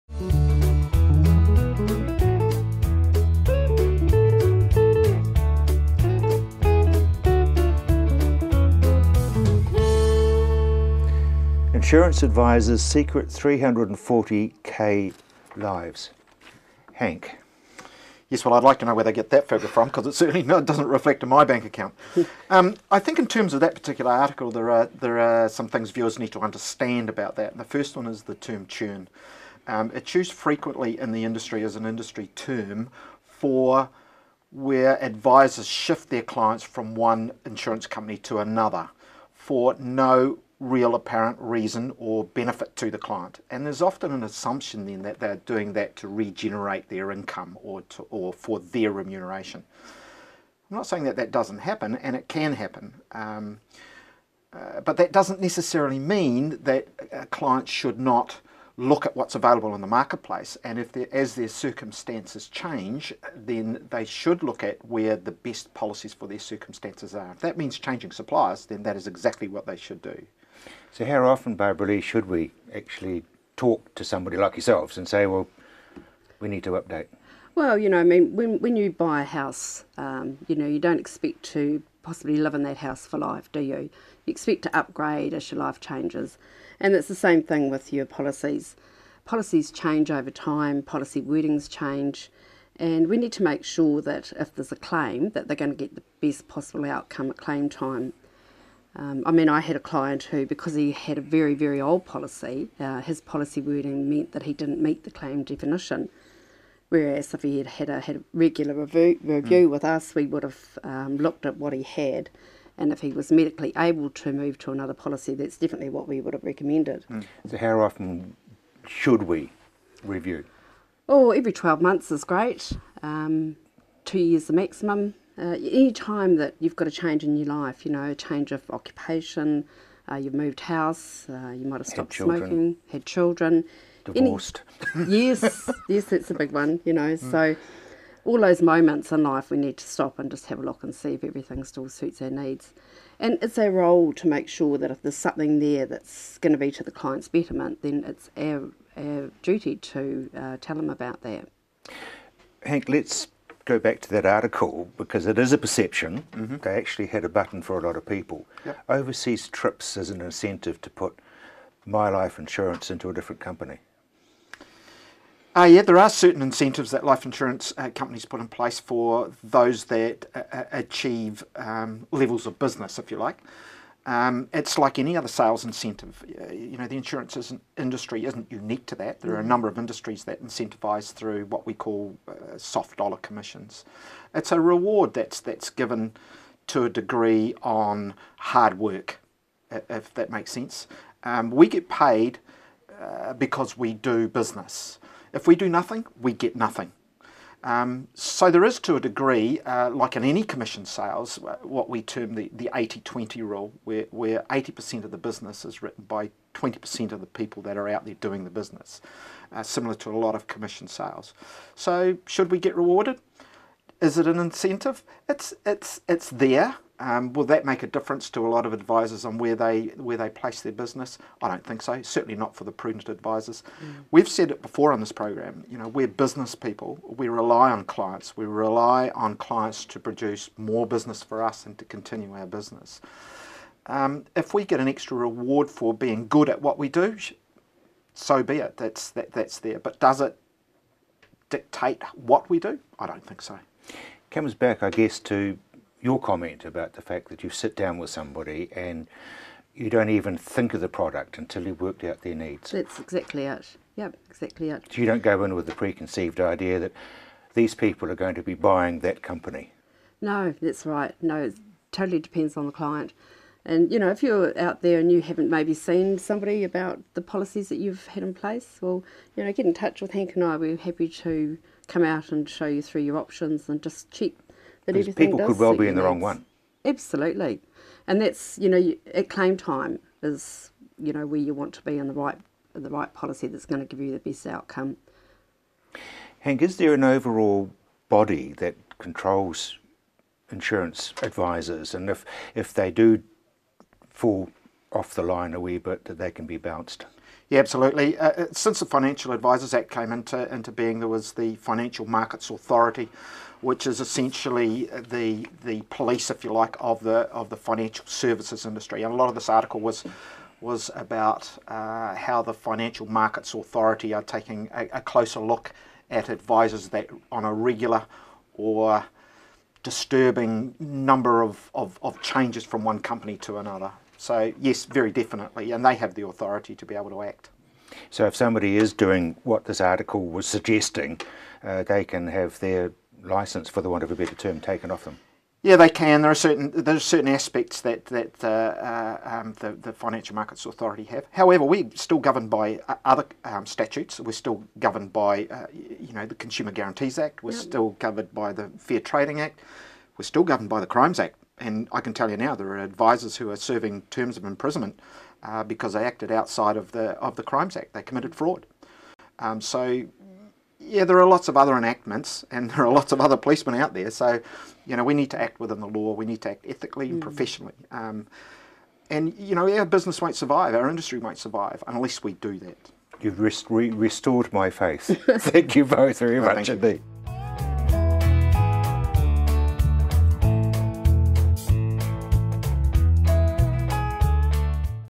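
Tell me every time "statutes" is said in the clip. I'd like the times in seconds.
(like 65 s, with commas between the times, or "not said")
343 s.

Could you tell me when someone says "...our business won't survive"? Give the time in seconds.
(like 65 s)
369 s.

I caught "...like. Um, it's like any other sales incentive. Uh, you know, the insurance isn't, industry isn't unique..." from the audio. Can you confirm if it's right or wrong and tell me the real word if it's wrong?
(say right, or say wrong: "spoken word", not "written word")
right.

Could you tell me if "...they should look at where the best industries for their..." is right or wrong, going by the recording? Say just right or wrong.
wrong.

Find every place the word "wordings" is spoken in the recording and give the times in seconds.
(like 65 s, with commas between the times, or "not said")
91 s, 103 s.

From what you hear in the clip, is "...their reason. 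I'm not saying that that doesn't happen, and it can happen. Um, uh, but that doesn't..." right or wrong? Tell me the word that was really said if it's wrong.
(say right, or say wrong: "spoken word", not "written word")
wrong: "remuneration", not "reason".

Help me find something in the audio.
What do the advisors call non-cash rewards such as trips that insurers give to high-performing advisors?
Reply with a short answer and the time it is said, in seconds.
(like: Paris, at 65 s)
soft dollar commissions, at 182 s.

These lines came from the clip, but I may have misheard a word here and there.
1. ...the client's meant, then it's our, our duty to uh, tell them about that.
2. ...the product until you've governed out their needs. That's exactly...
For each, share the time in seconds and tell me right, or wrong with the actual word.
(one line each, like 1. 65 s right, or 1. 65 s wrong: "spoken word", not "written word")
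1. 146 s wrong: "betterment", not "meant"
2. 250 s wrong: "worked", not "governed".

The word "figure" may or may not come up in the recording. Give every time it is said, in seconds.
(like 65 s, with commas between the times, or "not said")
19 s.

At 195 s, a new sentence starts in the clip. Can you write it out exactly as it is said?
If we do nothing, we get nothing.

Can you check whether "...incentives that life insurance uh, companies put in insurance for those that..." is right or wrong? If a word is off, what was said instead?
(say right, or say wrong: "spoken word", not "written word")
wrong: "place", not "insurance".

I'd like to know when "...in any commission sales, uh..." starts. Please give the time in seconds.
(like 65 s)
200 s.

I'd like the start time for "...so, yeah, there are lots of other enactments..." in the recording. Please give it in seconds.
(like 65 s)
359 s.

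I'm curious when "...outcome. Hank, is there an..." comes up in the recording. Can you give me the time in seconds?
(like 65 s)
284 s.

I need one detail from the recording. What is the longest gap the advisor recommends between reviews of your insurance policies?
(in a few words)
2 years.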